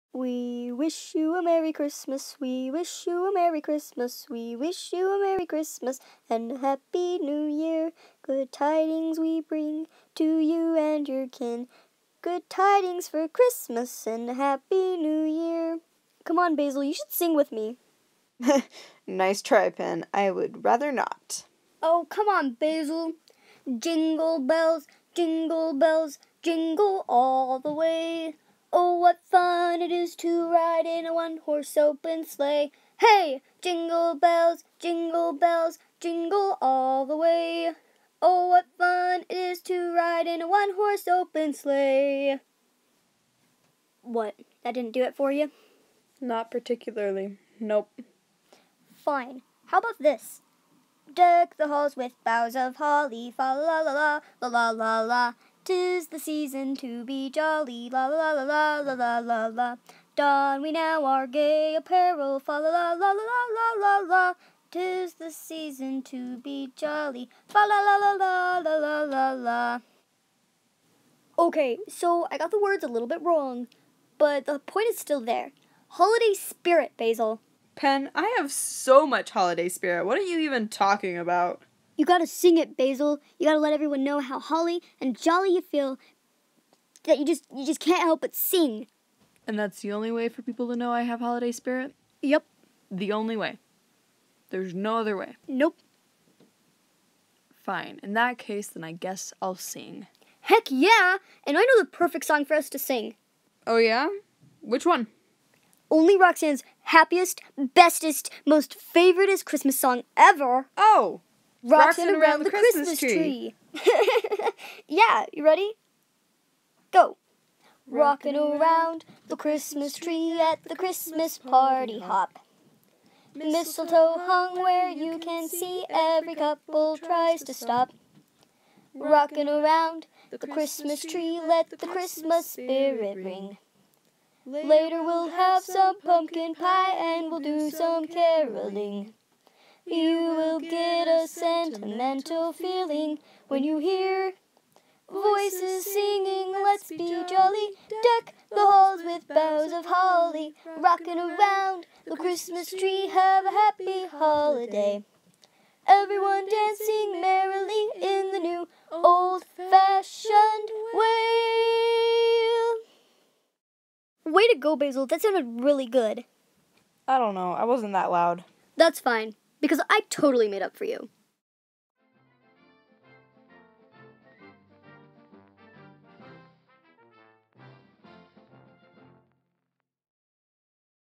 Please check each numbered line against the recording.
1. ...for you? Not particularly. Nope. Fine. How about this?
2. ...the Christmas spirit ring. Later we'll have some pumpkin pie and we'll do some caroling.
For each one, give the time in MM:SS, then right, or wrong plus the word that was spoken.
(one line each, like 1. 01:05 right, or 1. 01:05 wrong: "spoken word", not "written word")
1. 00:45 right
2. 02:11 right.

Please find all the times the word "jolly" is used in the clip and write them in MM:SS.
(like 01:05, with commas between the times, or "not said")
00:57, 01:06, 01:25, 02:27.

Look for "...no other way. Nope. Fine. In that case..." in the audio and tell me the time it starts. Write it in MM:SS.
01:34.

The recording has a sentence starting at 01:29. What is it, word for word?
And that's the only way for people to know I have holiday spirit?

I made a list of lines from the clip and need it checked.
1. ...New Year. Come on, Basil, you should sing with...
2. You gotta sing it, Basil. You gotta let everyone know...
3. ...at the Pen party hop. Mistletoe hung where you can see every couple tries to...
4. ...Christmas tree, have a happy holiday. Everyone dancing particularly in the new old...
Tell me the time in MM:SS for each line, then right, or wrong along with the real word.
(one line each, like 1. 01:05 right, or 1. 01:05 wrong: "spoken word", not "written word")
1. 00:14 right
2. 01:22 right
3. 02:00 wrong: "Christmas", not "Pen"
4. 02:32 wrong: "merrily", not "particularly".